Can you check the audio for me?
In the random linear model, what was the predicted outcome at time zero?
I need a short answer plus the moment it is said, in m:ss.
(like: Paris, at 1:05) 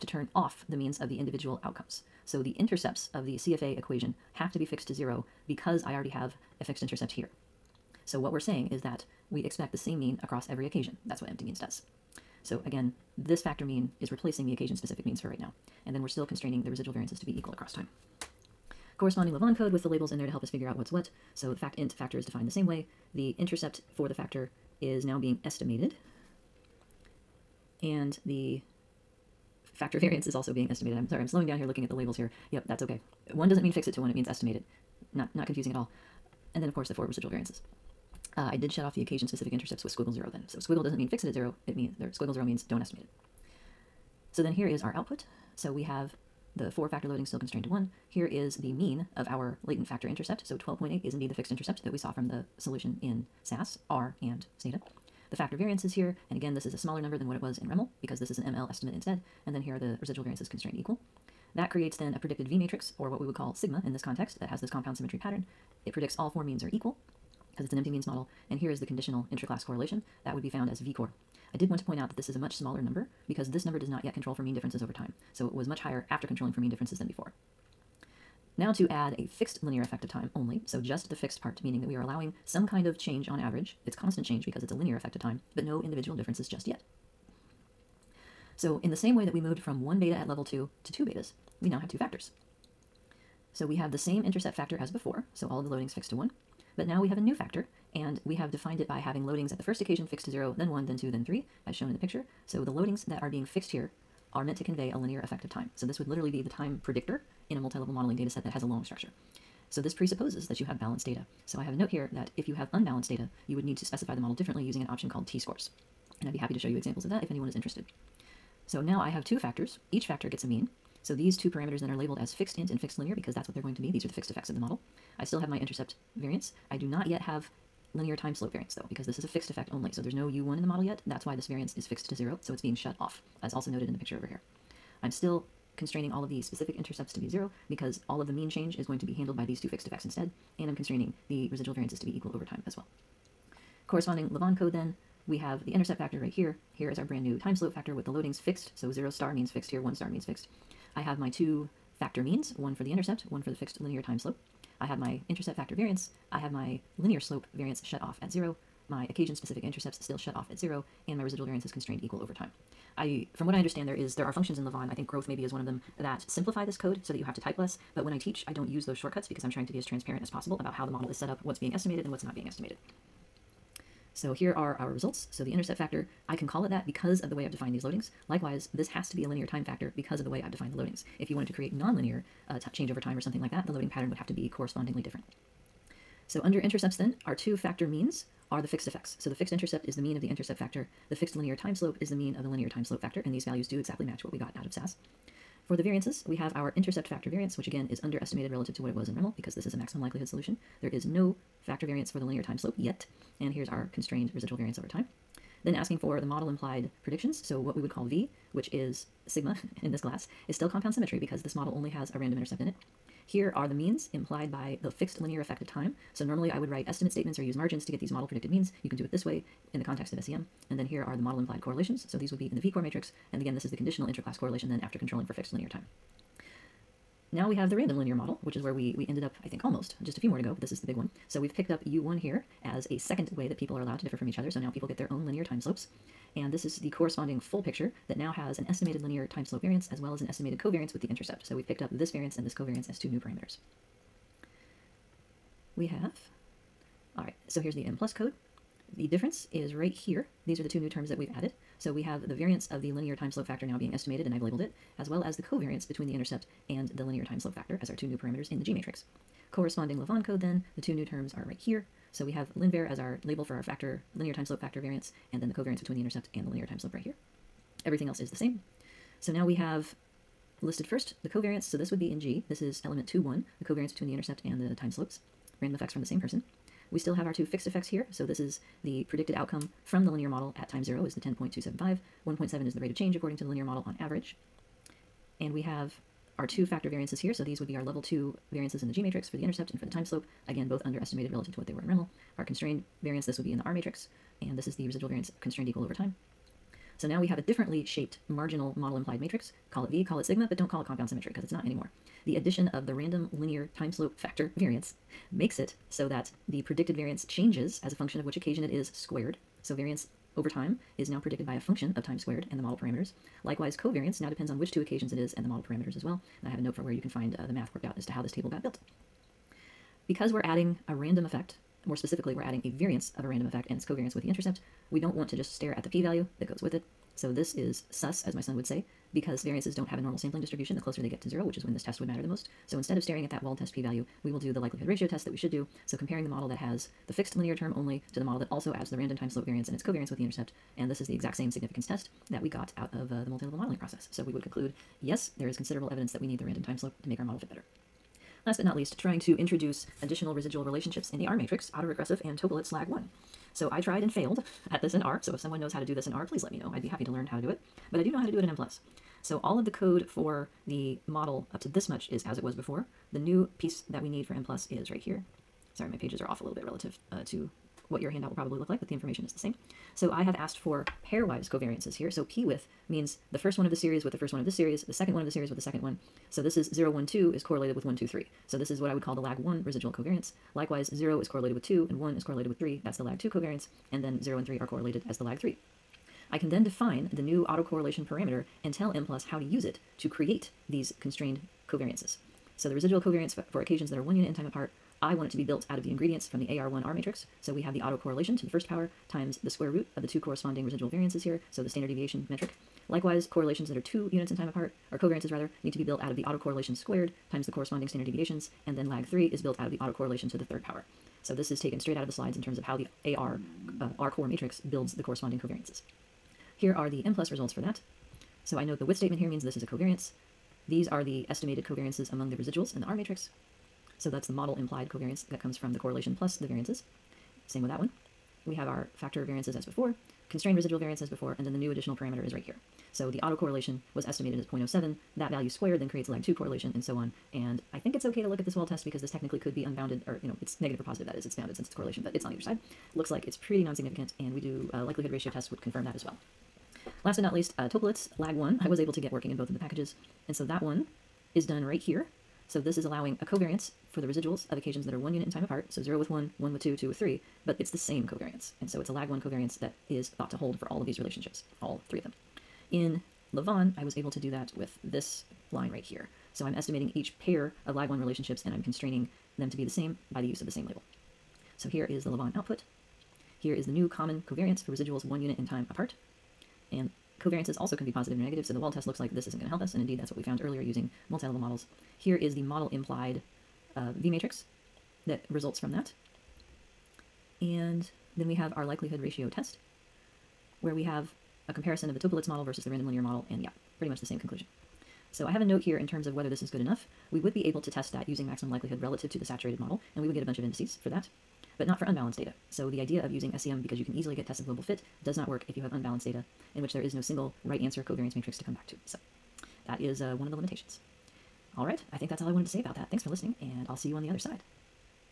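10.275, at 4:41.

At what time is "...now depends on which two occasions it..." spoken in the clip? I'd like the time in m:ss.
5:14.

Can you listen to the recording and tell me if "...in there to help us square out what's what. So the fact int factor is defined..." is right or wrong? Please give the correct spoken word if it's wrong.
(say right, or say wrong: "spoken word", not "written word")
wrong: "figure", not "square".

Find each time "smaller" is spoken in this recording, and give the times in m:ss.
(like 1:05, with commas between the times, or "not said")
0:56, 1:12.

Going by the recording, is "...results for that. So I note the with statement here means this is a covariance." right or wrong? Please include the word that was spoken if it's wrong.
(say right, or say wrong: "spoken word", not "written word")
right.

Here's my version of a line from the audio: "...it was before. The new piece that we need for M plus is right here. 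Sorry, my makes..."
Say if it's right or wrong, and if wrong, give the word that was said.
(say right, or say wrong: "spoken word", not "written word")
wrong: "pages", not "makes".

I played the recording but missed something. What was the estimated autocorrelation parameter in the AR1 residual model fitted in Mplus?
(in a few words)
0.07.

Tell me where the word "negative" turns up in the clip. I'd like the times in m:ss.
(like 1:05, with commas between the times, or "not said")
7:20, 7:58.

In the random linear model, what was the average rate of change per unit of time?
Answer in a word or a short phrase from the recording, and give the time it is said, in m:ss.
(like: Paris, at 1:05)
1.7, at 4:42.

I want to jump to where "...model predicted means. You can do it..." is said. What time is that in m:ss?
3:38.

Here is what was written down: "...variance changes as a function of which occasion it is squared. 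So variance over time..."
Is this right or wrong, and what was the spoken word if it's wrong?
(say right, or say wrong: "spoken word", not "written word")
right.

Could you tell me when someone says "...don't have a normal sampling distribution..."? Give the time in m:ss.
5:29.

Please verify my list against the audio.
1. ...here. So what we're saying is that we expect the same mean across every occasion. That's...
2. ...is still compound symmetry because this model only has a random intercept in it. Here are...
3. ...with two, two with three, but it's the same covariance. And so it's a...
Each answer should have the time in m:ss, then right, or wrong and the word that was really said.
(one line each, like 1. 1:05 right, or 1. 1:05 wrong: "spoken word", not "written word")
1. 0:07 right
2. 3:30 right
3. 7:36 right.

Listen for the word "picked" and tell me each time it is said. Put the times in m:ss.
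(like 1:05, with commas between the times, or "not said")
3:51, 4:01.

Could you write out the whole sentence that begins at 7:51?
So here is the lavaan output.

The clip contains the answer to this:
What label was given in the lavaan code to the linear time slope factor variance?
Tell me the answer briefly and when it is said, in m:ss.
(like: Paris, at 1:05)
Linvar, at 4:22.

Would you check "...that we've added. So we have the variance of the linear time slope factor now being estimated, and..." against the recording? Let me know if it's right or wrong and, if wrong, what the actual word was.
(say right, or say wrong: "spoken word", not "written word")
right.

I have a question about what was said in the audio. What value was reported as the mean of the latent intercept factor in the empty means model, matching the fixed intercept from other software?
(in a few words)
12.8.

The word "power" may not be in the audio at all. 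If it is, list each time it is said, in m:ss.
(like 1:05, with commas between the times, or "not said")
6:38, 6:50.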